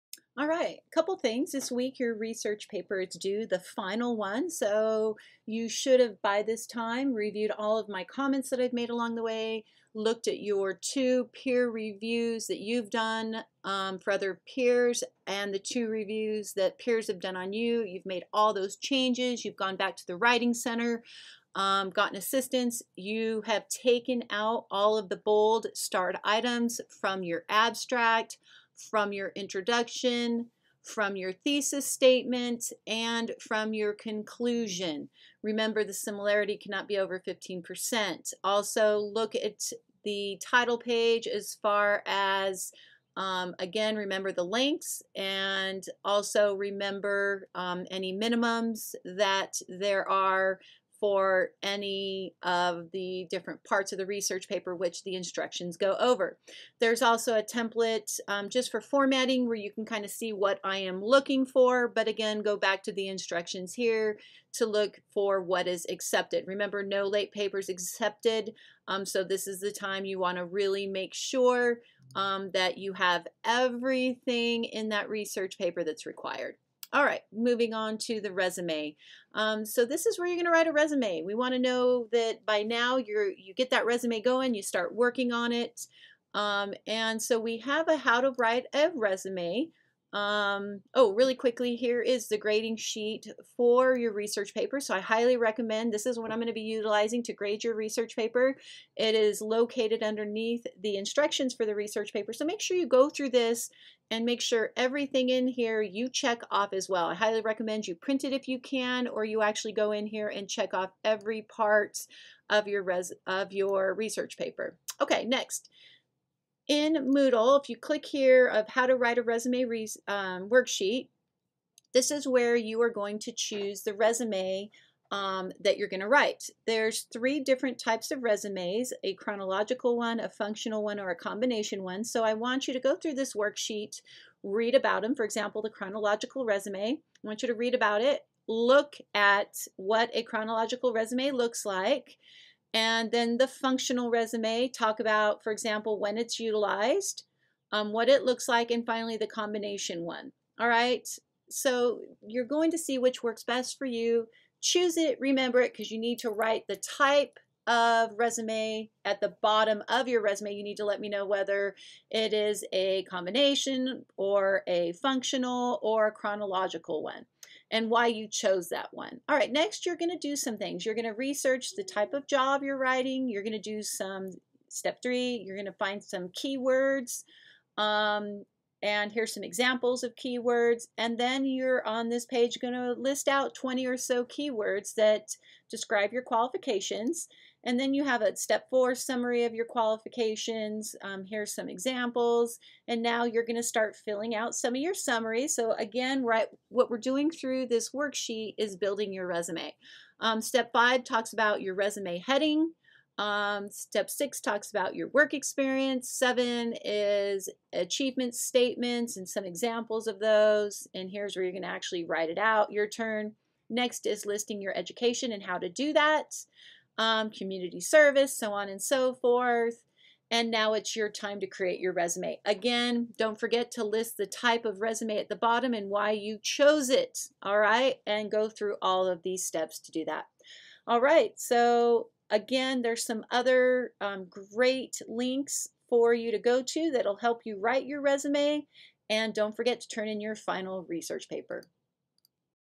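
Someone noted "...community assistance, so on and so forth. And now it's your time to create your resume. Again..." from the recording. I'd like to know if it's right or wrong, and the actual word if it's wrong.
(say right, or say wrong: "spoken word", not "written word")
wrong: "service", not "assistance".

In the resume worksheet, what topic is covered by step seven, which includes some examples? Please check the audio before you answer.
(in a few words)
Achievement statements.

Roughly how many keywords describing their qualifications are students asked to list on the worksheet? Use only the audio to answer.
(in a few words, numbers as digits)
20.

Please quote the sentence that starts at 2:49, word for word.
All right, next you're going to do some things.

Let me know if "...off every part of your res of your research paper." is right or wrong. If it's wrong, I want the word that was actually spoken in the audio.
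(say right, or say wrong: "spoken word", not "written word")
right.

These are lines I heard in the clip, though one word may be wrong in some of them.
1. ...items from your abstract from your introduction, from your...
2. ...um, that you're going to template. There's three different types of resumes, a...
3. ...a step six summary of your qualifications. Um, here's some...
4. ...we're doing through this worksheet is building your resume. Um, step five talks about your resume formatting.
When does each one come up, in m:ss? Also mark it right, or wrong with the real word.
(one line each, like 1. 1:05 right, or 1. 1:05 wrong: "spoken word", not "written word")
1. 0:26 right
2. 2:05 wrong: "write", not "template"
3. 3:08 wrong: "four", not "six"
4. 3:16 wrong: "heading", not "formatting".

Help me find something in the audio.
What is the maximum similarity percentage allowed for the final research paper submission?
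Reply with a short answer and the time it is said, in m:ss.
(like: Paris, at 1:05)
15%, at 0:37.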